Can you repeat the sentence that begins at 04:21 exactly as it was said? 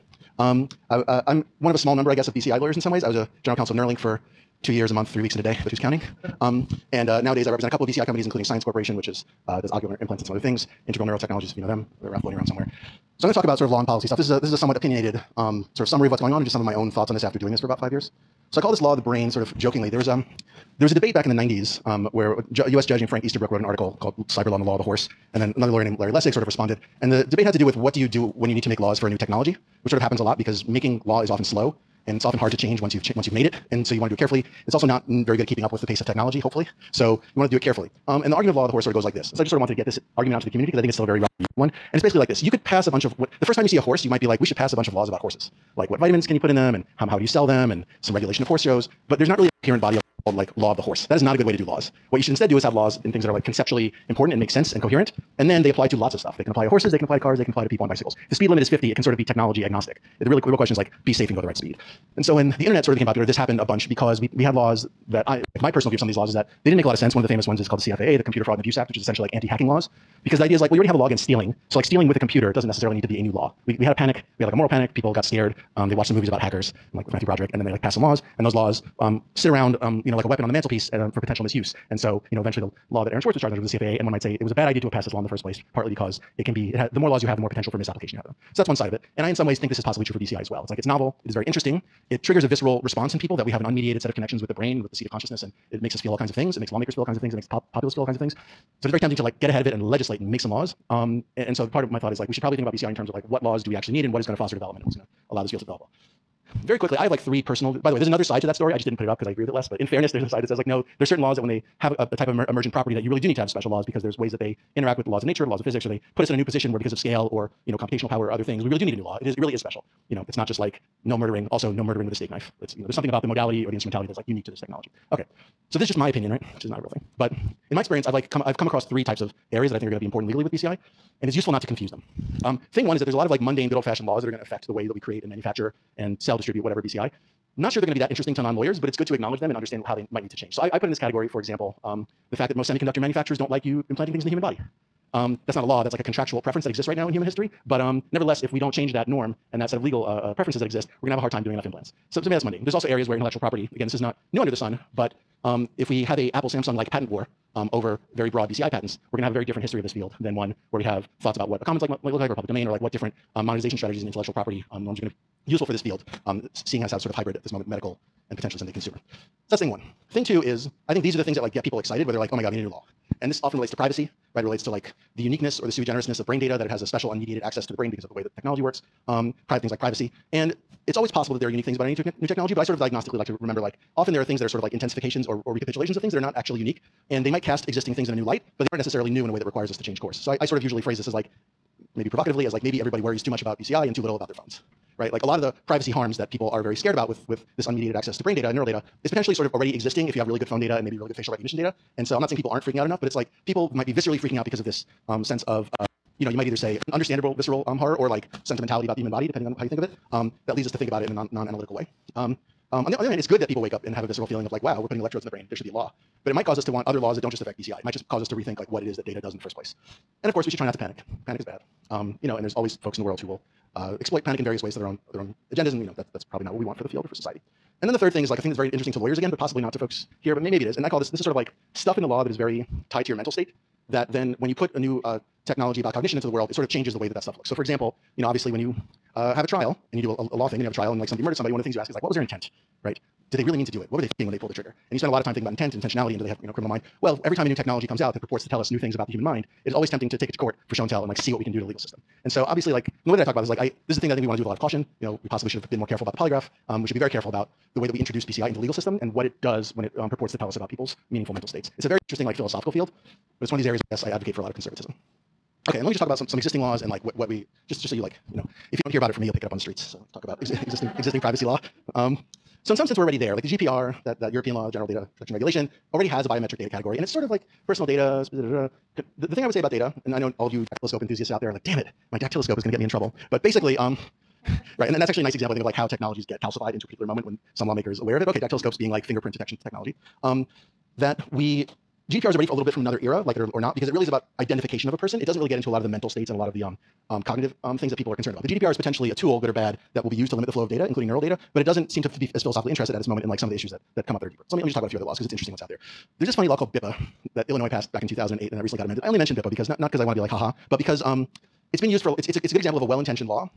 It's a very interesting, like, philosophical field, but it's one of these areas where yes, I advocate for a lot of conservatism.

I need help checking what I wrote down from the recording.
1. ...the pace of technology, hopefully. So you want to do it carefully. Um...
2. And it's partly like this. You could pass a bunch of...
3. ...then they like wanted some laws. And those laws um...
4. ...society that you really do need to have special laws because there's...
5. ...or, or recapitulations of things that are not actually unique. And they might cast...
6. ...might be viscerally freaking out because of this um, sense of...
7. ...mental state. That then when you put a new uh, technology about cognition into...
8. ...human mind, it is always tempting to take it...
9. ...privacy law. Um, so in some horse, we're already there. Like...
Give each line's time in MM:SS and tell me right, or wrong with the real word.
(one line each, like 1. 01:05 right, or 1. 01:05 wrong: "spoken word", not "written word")
1. 00:35 right
2. 00:41 wrong: "basically", not "partly"
3. 01:17 wrong: "passed", not "wanted"
4. 01:52 wrong: "property", not "society"
5. 03:05 right
6. 03:23 right
7. 03:53 right
8. 04:09 right
9. 04:31 wrong: "sense", not "horse".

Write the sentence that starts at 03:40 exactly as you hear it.
And of course, we should try not to panic.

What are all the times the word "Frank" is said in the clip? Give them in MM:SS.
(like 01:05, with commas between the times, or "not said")
00:23.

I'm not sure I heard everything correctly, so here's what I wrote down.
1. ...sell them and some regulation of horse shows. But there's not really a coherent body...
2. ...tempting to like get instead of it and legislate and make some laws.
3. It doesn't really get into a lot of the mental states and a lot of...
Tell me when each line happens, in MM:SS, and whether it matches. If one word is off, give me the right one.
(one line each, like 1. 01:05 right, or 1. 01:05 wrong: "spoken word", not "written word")
1. 00:47 right
2. 01:38 wrong: "ahead", not "instead"
3. 04:55 right.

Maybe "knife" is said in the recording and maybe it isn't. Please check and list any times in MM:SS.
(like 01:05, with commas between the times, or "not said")
02:02.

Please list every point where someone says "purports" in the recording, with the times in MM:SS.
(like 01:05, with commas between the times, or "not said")
04:08, 04:20.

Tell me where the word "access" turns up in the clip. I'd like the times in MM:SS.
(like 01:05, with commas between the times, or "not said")
02:57, 03:17.